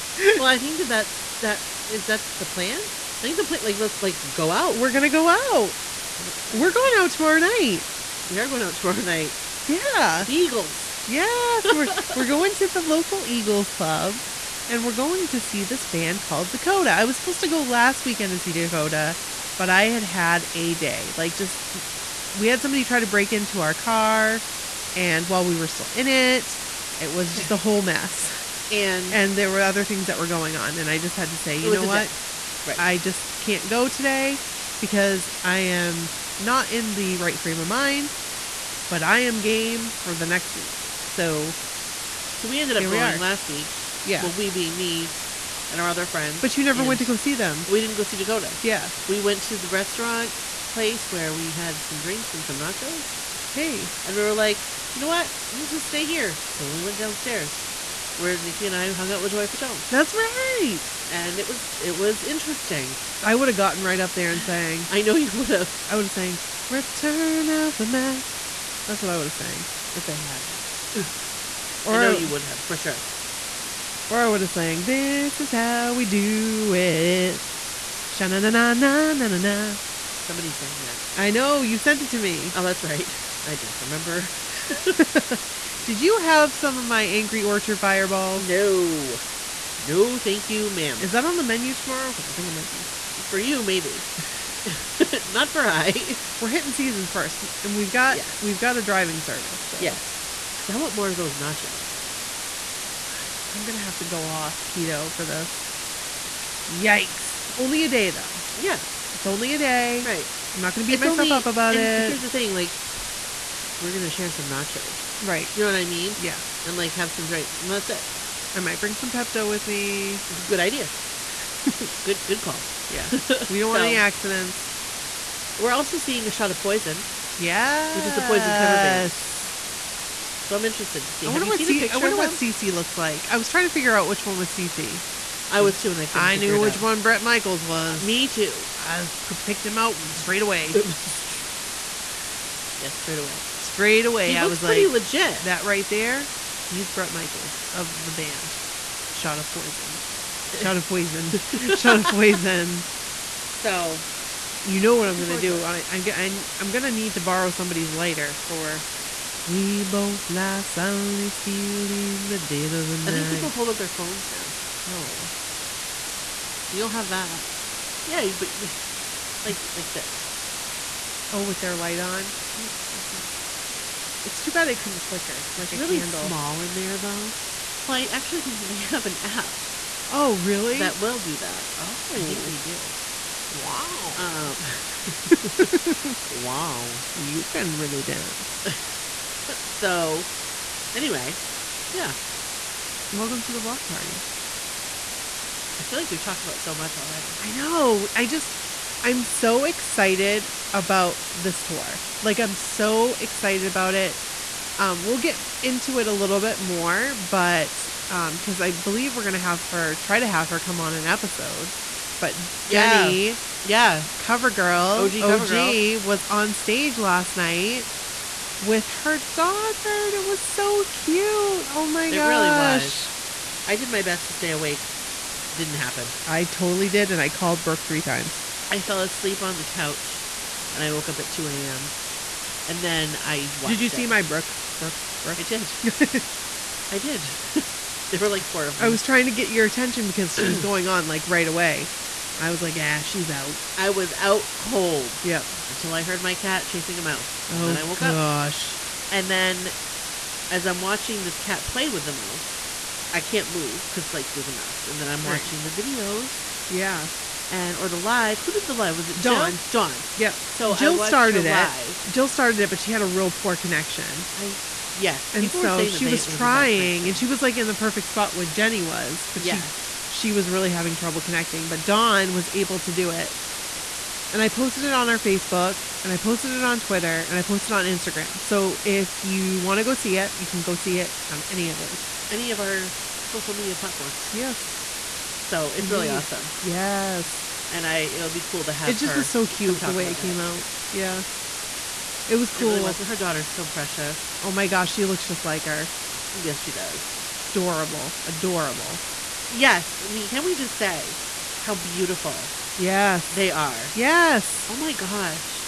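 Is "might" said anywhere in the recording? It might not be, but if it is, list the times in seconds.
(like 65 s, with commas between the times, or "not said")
92 s, 118 s.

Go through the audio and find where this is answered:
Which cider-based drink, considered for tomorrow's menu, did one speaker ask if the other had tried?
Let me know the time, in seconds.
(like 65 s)
87 s.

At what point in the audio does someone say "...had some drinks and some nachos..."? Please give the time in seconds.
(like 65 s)
51 s.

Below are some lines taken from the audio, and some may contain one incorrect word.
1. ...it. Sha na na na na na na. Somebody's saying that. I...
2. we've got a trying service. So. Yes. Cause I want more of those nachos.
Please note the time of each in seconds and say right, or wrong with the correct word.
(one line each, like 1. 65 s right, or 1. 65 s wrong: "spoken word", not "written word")
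1. 76 s right
2. 98 s wrong: "driving", not "trying".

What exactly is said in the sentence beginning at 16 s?
I was supposed to go last weekend to see Dakota, but I had had a day.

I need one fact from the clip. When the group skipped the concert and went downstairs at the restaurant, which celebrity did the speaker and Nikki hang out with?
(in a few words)
Joey Fatone.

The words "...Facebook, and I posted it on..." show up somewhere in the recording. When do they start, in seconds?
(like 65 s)
275 s.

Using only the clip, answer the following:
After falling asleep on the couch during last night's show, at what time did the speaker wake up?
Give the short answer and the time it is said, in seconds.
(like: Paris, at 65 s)
2 a.m., at 231 s.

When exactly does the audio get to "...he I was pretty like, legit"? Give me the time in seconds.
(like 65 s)
144 s.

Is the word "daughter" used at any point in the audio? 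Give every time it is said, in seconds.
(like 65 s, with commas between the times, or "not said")
219 s, 293 s.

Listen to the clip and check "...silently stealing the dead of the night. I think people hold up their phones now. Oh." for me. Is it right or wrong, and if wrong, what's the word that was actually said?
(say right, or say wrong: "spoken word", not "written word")
right.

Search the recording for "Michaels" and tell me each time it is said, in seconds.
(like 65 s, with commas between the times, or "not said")
137 s, 147 s.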